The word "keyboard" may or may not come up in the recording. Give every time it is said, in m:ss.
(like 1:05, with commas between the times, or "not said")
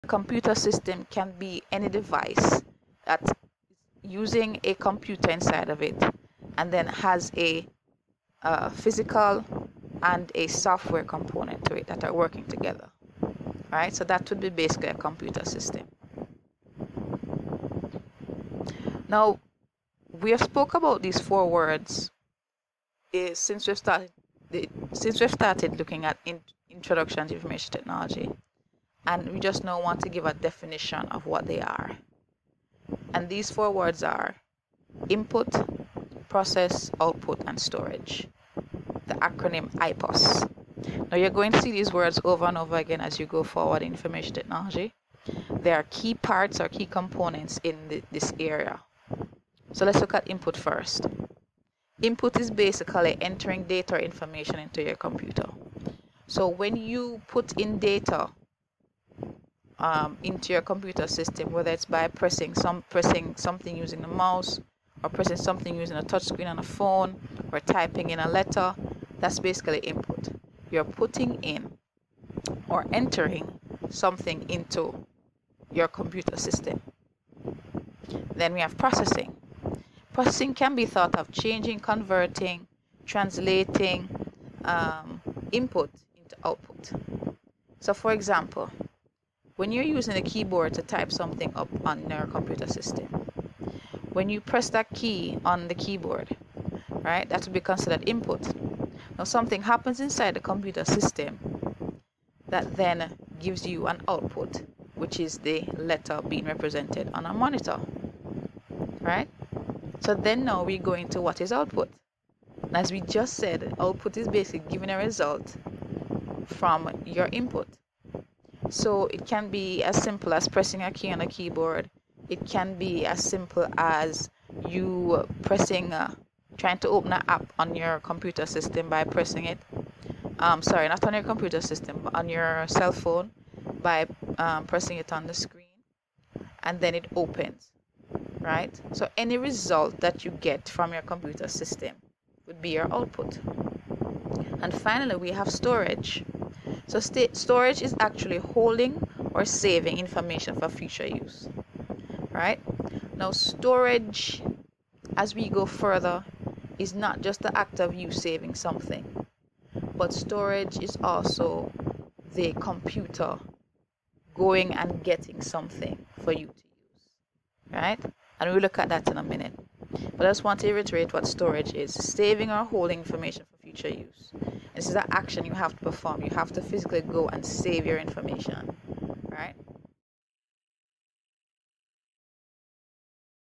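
1:30, 1:35, 2:01.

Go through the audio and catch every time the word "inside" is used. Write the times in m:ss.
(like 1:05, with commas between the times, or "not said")
0:05, 1:39.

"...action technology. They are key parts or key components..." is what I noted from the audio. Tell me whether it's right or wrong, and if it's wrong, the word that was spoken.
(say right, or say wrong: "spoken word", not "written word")
wrong: "information", not "action".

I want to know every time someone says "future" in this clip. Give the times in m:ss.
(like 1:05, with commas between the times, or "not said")
2:30, 2:53.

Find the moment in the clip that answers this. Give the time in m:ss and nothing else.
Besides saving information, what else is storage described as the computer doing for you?
2:44.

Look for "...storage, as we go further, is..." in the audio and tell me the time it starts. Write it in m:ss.
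2:33.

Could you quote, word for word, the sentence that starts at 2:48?
And we'll look at that in a minute.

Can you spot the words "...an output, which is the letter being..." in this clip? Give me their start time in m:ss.
1:43.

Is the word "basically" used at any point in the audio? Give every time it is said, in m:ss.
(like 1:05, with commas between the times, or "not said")
0:14, 0:52, 1:09, 1:54.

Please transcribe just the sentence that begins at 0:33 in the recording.
And these four words are input, process, output, and storage.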